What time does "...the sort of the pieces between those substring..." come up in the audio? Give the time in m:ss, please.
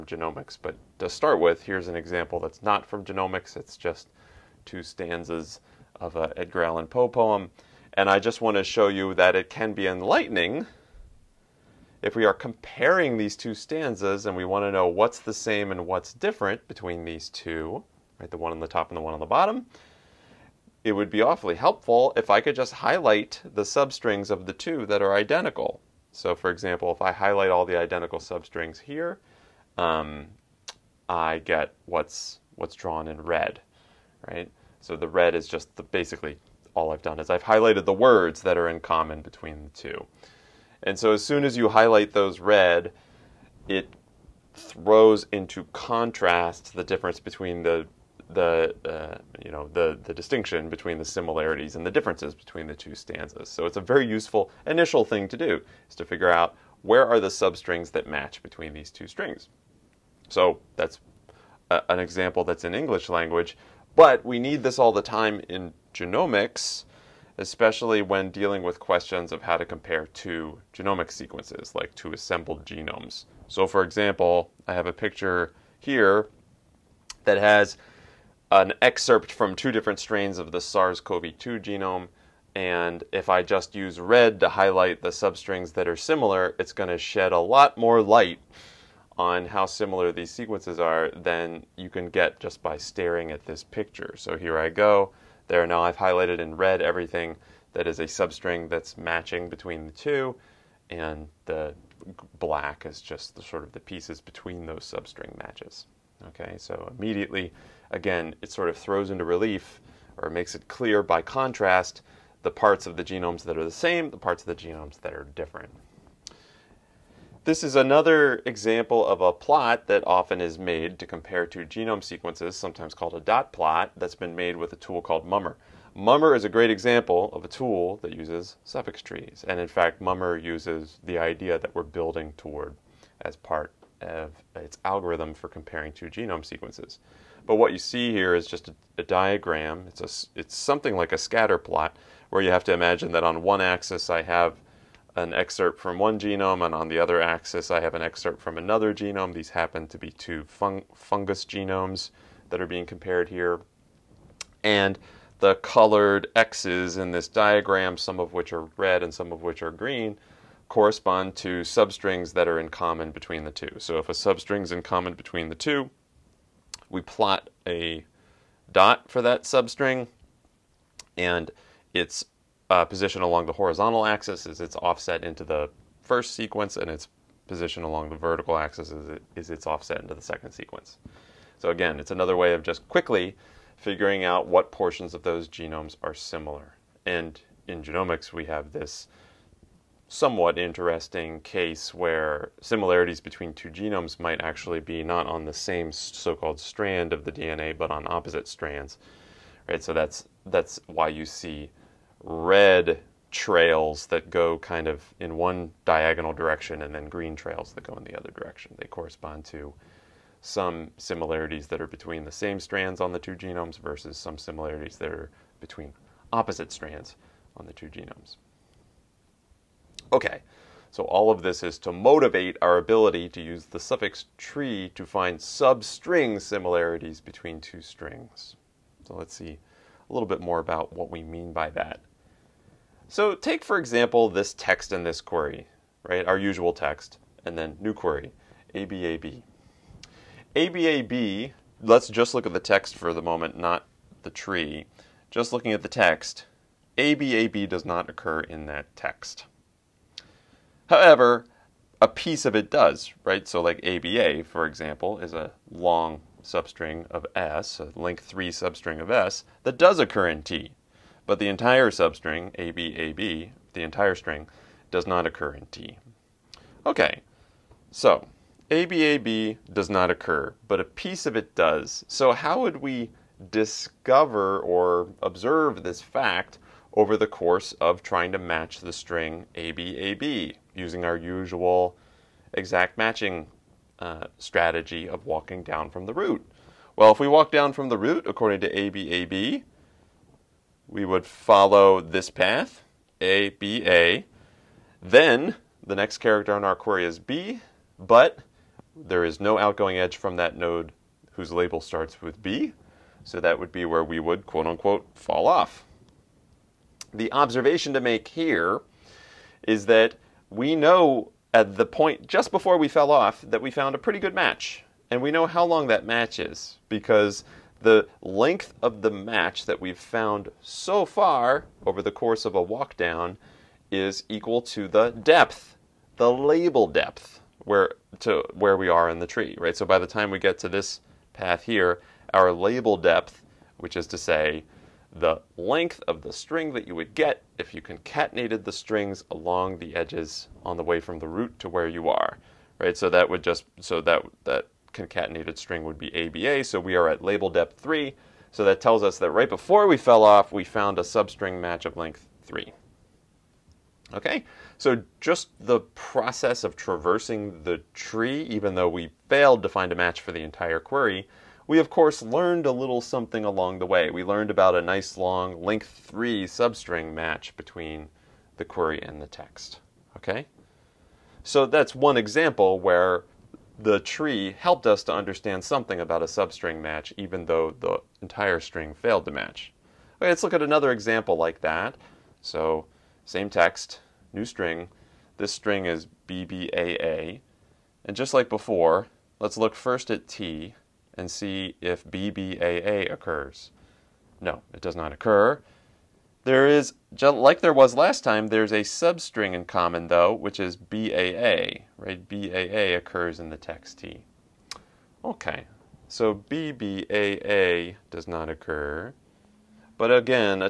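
1:43.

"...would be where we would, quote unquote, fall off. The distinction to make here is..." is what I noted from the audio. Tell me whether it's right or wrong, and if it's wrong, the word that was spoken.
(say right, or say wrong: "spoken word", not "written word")
wrong: "observation", not "distinction".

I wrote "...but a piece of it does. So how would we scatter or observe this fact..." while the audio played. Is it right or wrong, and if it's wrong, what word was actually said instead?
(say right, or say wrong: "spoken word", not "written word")
wrong: "discover", not "scatter".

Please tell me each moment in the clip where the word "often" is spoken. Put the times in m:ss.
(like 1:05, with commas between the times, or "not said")
2:00.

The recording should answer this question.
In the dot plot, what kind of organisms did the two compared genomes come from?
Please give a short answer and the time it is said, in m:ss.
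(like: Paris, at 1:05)
fungus, at 2:30.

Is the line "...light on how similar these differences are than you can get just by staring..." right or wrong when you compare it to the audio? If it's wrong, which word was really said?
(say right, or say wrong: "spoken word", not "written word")
wrong: "sequences", not "differences".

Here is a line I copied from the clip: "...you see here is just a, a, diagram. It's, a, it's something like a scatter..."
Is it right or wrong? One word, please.
right.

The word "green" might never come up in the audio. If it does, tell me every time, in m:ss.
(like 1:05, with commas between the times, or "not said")
2:39, 3:27.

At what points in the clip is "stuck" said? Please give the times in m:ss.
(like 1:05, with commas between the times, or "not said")
not said.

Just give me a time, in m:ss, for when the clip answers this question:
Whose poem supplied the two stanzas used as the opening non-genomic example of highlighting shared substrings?
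0:06.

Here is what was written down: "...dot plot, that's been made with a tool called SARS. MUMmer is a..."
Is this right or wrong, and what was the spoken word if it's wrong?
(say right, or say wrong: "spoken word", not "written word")
wrong: "MUMmer", not "SARS".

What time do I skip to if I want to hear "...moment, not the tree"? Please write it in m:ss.
4:03.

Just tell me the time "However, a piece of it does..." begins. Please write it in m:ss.
4:10.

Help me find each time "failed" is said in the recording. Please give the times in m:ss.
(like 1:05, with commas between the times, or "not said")
5:59, 6:18.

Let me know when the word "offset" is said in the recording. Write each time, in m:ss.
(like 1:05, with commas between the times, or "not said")
2:54, 2:59.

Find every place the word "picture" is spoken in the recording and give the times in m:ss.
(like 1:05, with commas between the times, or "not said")
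1:14, 1:33.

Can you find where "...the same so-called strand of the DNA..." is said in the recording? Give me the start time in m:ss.
3:15.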